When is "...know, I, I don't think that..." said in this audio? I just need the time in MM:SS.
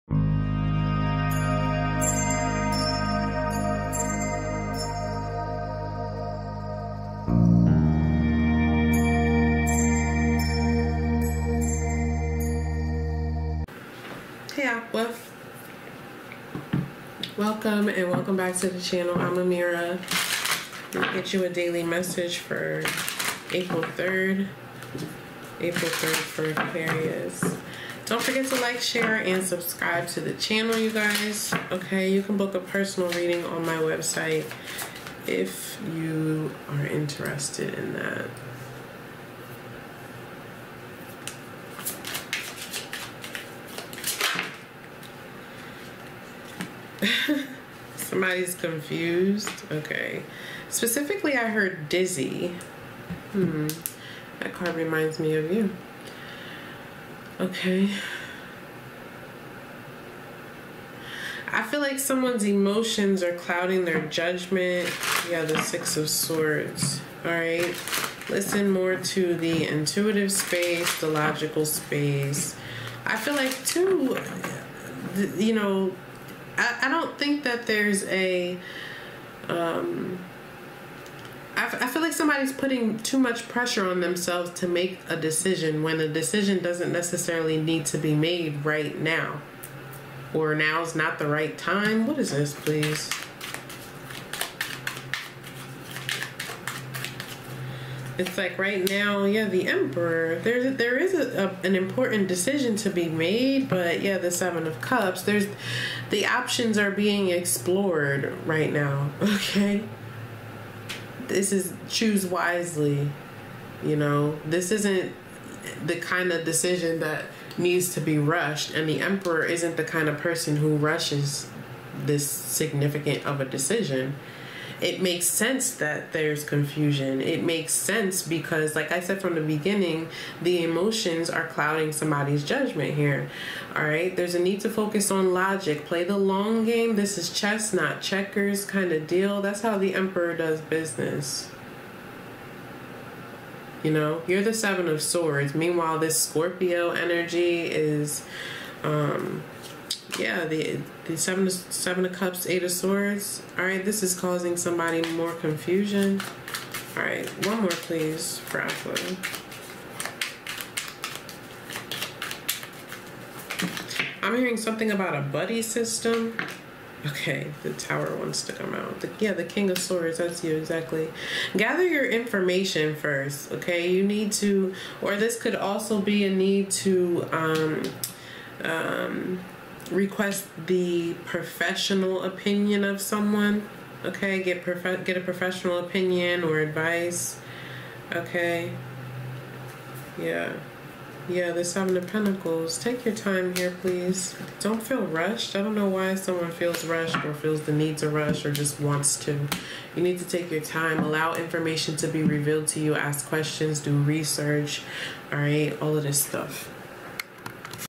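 01:15.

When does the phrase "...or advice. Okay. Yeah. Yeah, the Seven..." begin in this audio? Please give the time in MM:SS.
03:06.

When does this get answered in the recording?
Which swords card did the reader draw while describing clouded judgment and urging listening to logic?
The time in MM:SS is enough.
01:05.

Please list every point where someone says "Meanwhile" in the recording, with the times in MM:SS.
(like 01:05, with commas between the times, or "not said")
02:25.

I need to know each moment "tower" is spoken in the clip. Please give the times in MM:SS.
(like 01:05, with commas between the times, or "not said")
02:47.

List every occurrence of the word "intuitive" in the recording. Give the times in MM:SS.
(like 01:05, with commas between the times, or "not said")
01:09.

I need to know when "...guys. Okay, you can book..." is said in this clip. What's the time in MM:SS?
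00:30.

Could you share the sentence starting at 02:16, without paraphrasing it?
This is chess, not checkers kind of deal.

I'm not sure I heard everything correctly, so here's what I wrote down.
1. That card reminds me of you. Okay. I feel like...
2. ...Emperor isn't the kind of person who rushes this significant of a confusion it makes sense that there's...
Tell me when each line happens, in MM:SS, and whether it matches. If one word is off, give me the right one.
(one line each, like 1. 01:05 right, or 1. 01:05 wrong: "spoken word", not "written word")
1. 00:54 right
2. 01:59 wrong: "decision", not "confusion".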